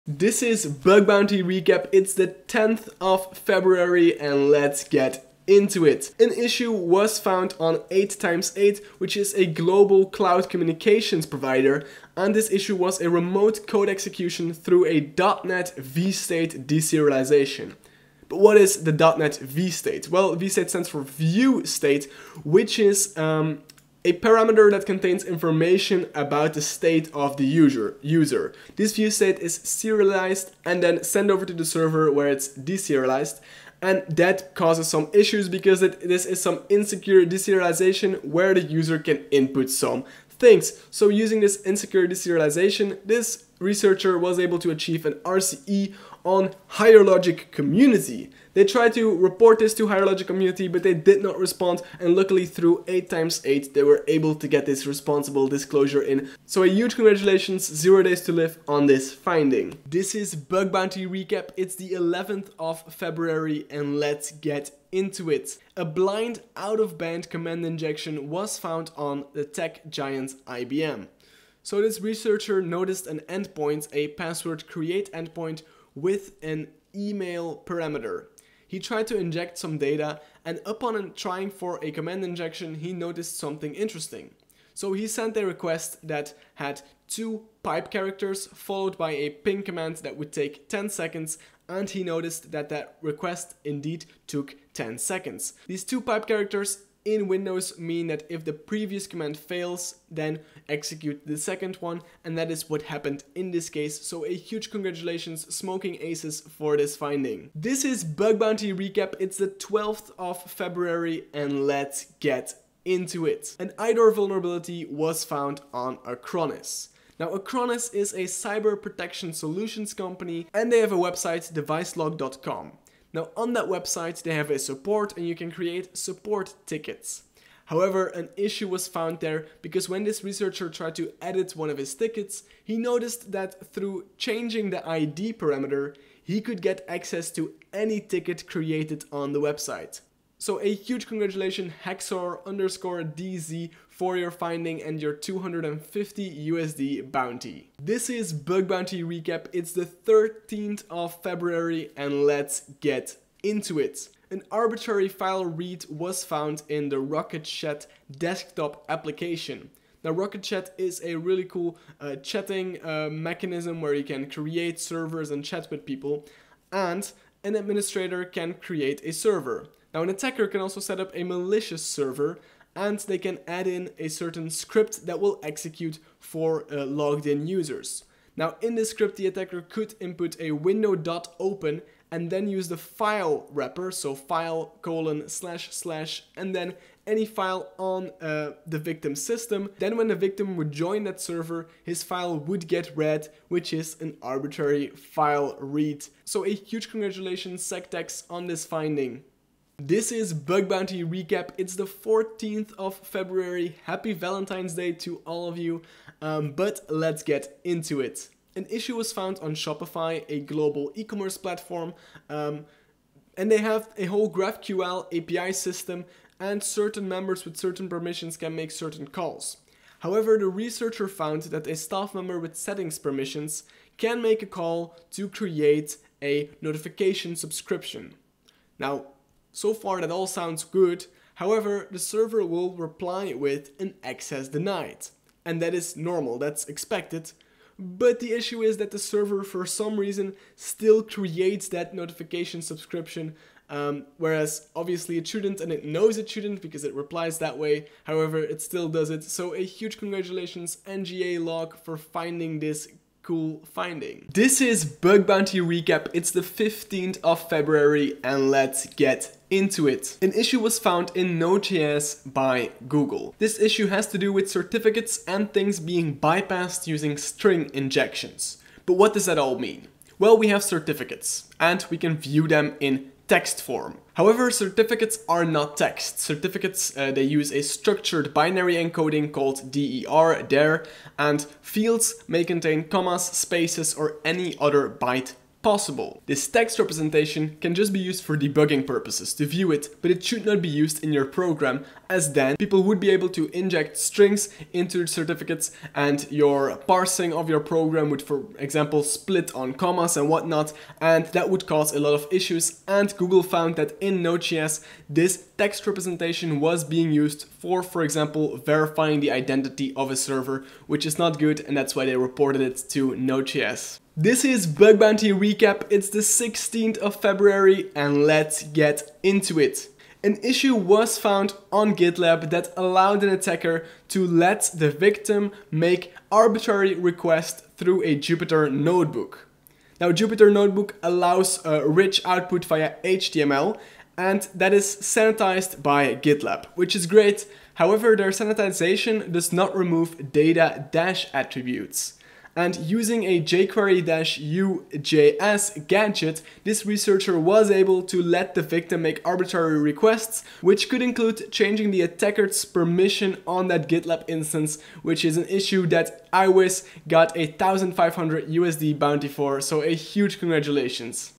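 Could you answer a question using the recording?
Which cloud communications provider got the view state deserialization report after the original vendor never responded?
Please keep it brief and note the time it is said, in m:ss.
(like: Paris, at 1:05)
8x8, at 0:07.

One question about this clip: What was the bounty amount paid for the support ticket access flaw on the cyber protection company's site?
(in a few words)
250 USD.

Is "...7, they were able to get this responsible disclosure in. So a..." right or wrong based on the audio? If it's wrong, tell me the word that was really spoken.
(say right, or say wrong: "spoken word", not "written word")
wrong: "8", not "7".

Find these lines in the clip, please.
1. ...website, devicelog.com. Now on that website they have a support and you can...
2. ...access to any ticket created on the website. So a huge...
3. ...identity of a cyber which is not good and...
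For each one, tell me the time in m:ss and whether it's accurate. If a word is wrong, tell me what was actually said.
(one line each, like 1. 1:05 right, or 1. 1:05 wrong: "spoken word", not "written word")
1. 2:00 right
2. 2:16 right
3. 5:09 wrong: "server", not "cyber".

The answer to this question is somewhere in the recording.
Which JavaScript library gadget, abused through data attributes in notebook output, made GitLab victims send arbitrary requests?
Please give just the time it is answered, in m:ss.
5:43.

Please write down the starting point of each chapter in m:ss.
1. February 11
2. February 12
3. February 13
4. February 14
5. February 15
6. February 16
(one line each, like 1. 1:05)
1. 0:59
2. 1:44
3. 2:28
4. 3:19
5. 4:12
6. 5:13.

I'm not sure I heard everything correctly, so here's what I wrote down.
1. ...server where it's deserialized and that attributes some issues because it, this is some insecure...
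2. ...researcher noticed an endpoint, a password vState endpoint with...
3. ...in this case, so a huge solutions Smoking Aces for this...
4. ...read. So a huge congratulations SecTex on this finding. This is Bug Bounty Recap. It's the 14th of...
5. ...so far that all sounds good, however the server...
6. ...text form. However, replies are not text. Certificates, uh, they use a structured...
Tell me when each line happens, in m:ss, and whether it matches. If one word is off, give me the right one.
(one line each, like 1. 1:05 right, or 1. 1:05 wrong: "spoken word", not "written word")
1. 0:31 wrong: "causes", not "attributes"
2. 1:12 wrong: "create", not "vState"
3. 1:43 wrong: "congratulations", not "solutions"
4. 3:15 right
5. 3:49 right
6. 4:33 wrong: "certificates", not "replies".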